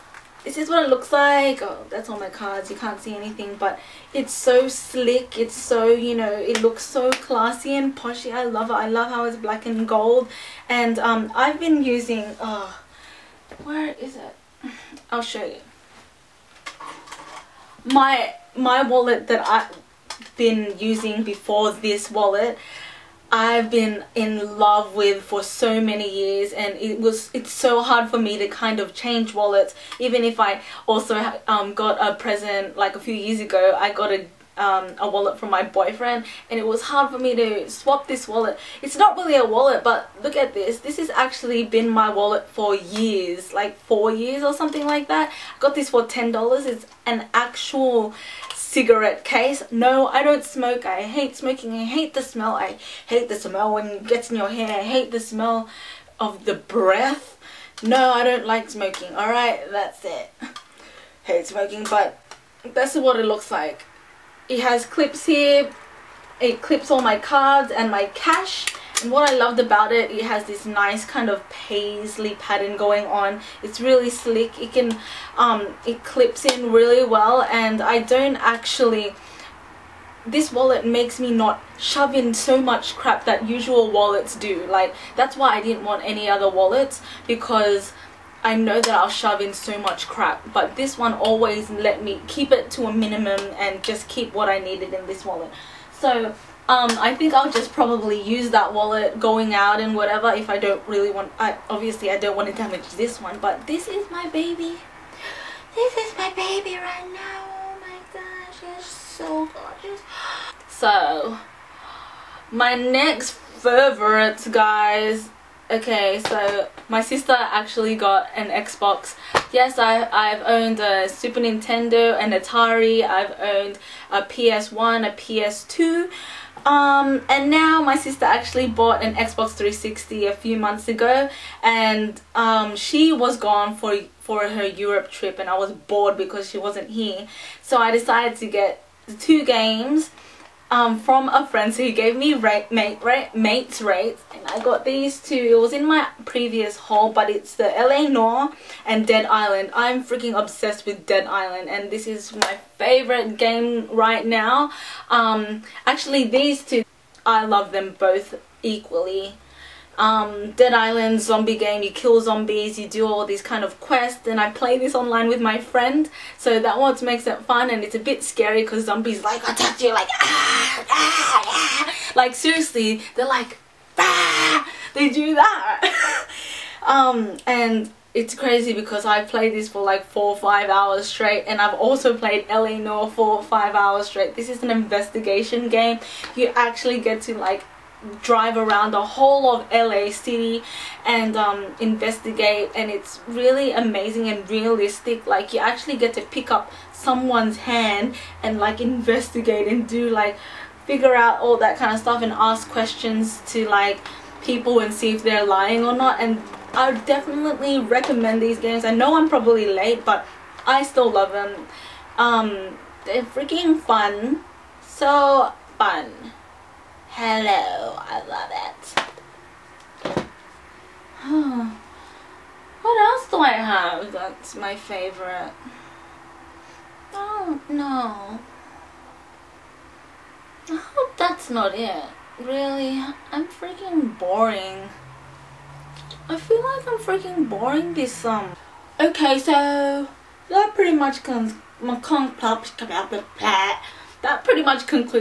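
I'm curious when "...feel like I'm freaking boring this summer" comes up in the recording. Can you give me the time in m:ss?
3:56.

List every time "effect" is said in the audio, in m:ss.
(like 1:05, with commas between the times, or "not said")
not said.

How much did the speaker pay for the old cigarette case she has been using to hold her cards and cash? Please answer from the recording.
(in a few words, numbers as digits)
$10.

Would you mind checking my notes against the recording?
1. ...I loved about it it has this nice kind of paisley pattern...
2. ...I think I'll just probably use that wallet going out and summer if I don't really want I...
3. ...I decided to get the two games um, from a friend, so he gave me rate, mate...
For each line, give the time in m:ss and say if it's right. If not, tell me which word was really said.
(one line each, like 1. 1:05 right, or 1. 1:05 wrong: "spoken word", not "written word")
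1. 1:09 right
2. 1:37 wrong: "whatever", not "summer"
3. 2:17 right.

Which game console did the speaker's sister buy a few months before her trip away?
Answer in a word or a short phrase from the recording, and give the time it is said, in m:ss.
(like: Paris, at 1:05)
Xbox 360, at 2:09.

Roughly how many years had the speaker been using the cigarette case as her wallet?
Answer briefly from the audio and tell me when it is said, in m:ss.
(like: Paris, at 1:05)
4 years, at 0:43.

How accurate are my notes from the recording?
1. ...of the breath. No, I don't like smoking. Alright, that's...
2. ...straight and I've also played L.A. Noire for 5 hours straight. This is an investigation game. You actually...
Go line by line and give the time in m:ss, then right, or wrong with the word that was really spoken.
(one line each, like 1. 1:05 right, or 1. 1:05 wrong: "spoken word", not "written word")
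1. 0:56 right
2. 3:01 right.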